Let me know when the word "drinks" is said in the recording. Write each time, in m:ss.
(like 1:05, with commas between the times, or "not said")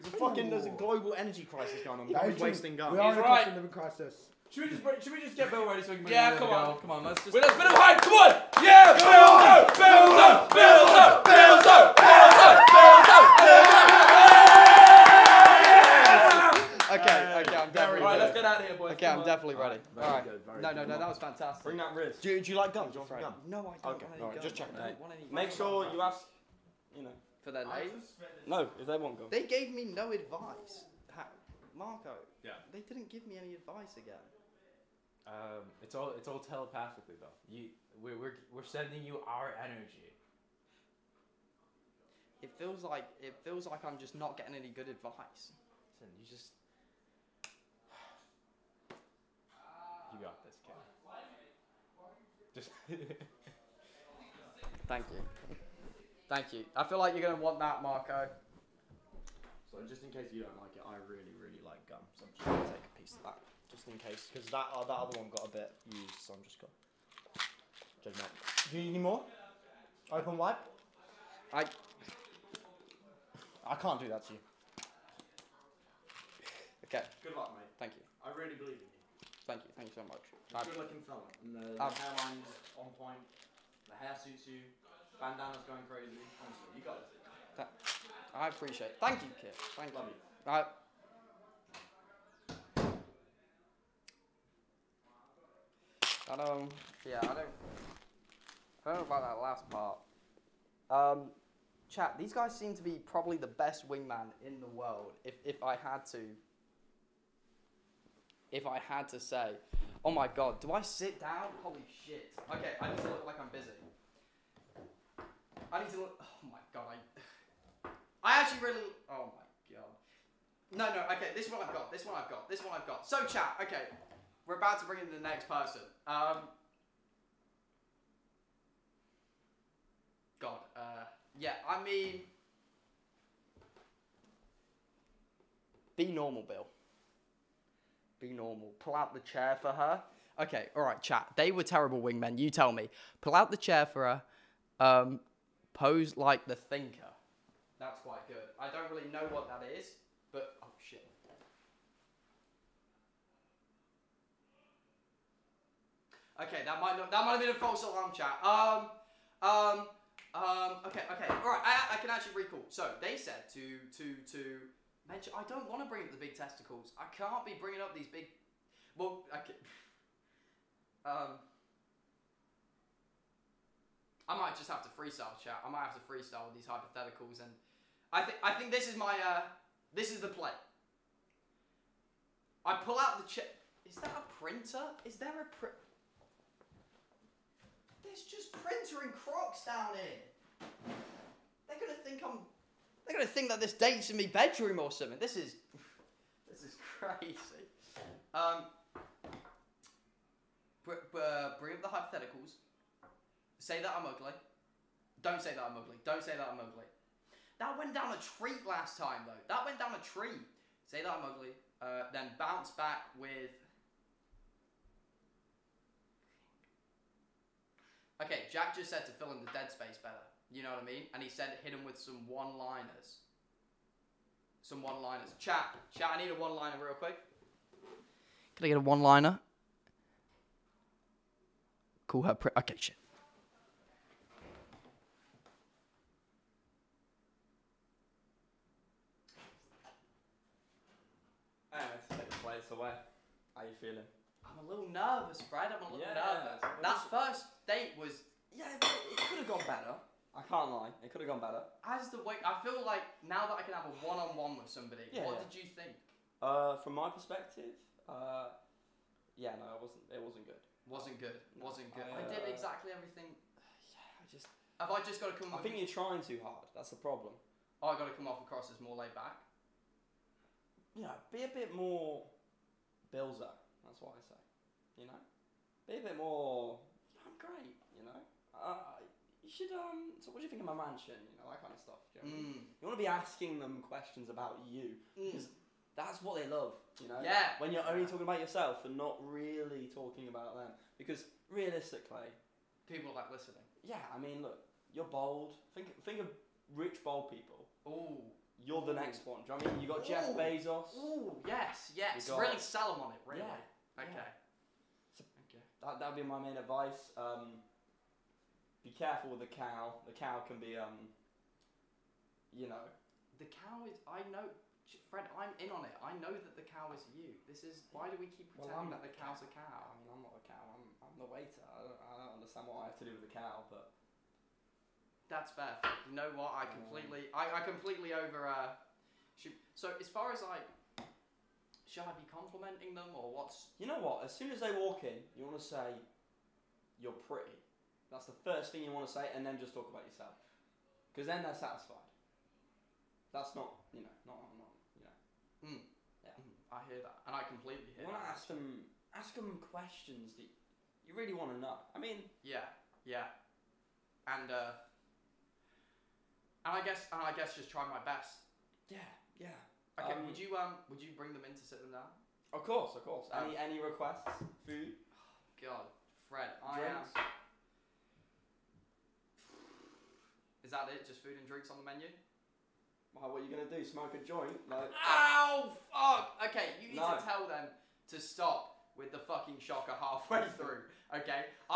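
6:06, 6:11.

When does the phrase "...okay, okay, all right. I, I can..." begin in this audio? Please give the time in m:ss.
2:40.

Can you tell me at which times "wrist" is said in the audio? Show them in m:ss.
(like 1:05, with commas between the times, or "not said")
0:21.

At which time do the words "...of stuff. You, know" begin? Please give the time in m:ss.
4:41.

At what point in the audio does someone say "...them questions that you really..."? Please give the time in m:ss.
5:49.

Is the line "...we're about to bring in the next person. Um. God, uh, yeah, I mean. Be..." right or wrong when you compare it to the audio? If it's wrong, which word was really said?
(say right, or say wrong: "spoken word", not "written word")
right.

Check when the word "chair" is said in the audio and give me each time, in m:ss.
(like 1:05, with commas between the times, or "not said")
2:19, 2:23.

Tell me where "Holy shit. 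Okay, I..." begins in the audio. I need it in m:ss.
1:51.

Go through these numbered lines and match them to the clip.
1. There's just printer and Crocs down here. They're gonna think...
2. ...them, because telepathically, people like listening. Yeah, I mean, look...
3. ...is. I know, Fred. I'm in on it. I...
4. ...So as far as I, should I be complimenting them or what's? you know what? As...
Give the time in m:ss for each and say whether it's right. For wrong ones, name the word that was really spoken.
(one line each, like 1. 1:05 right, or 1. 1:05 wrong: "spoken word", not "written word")
1. 3:08 right
2. 4:50 wrong: "realistically", not "telepathically"
3. 5:13 right
4. 5:29 right.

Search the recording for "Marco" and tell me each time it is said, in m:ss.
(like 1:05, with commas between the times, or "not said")
0:31, 0:57.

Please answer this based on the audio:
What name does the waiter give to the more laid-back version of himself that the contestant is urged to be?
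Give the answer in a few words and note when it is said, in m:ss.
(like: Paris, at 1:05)
Bilzer, at 4:33.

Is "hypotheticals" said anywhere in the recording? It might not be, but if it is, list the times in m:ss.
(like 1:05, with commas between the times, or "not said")
2:56, 3:21.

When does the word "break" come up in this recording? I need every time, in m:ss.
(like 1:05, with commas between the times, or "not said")
0:04.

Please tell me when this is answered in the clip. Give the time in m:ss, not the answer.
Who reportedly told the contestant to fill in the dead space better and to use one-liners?
3:38.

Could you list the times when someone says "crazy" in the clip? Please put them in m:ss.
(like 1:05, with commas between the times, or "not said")
1:25, 3:16.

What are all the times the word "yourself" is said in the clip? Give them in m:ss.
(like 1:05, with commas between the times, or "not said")
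4:48, 5:40.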